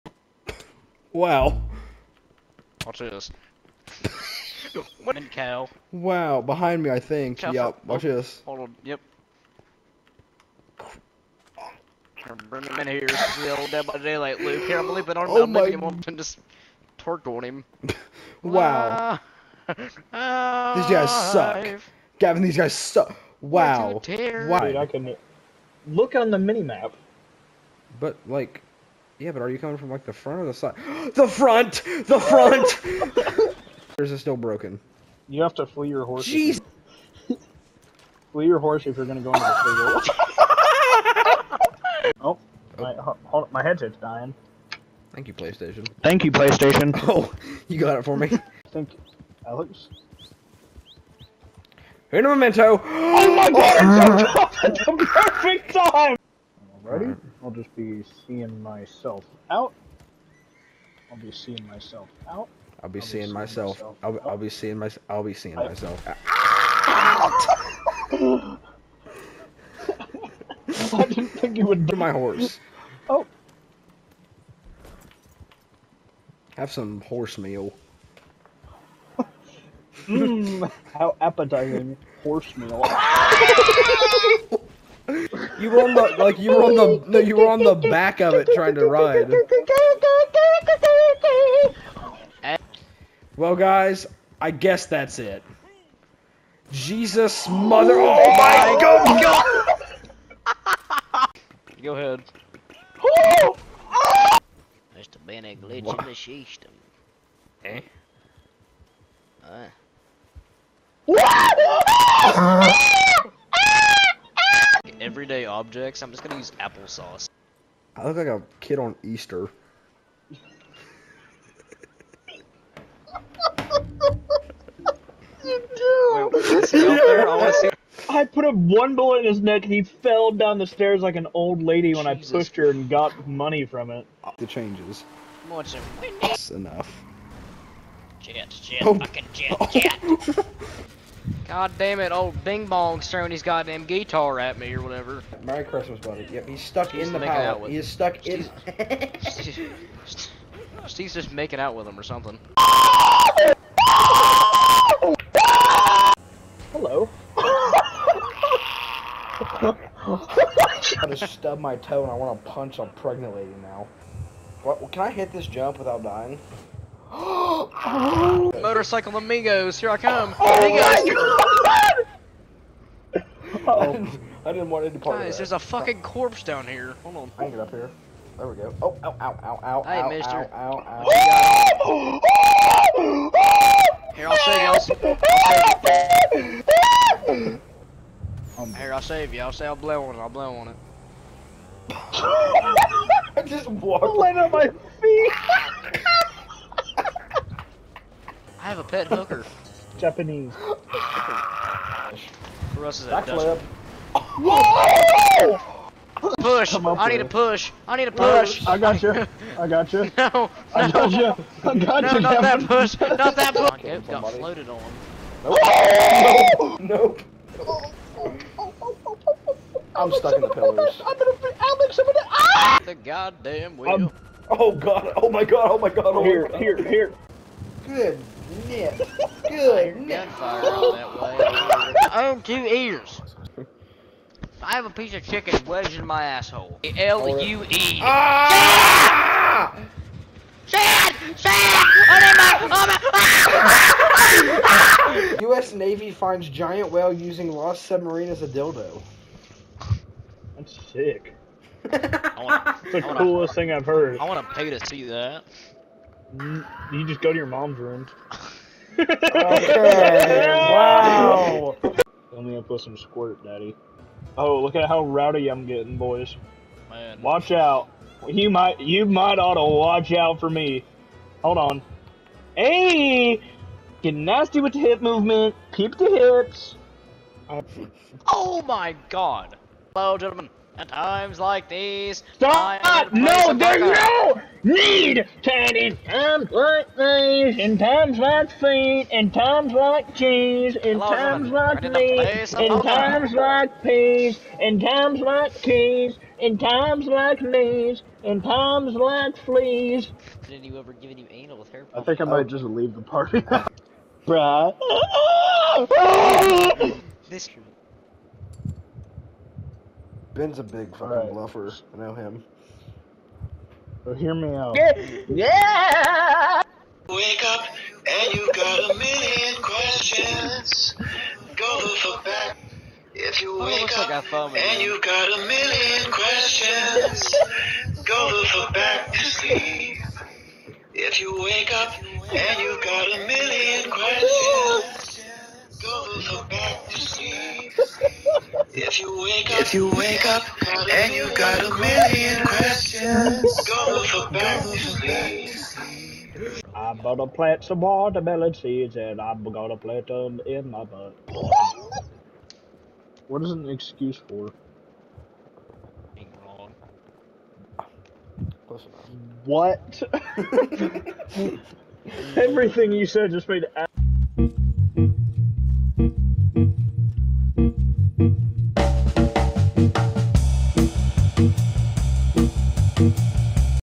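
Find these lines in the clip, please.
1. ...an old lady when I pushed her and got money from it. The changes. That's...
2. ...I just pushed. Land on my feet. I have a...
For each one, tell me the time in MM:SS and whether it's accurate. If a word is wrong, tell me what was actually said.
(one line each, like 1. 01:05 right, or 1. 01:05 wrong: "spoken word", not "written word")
1. 02:11 right
2. 03:13 wrong: "walked", not "pushed".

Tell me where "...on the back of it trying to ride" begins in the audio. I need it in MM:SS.
01:27.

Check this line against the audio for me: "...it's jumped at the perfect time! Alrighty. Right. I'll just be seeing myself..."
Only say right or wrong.
right.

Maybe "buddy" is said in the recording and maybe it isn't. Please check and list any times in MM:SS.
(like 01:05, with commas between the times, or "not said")
02:25.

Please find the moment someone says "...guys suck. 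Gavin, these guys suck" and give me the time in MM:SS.
00:20.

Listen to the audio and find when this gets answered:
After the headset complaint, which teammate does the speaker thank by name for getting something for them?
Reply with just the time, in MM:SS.
00:49.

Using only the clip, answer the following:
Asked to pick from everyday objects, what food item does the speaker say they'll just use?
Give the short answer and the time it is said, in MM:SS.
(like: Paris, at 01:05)
applesauce, at 01:56.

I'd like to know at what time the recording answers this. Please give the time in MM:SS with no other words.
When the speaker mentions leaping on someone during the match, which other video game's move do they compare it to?
00:13.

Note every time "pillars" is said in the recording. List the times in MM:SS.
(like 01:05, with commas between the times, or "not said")
03:40.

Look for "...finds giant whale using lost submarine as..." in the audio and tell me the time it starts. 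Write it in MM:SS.
04:06.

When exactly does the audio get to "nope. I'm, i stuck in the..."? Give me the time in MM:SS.
03:37.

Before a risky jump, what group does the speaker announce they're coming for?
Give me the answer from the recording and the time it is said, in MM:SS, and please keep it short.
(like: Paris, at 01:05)
Motorcycle amigos, at 02:48.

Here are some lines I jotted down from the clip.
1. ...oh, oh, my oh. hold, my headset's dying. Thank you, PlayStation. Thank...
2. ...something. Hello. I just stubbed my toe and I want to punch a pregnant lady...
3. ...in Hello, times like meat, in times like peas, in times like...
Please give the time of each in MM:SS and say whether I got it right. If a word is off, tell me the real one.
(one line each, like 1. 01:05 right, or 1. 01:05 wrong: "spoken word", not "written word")
1. 00:42 right
2. 02:32 right
3. 04:50 right.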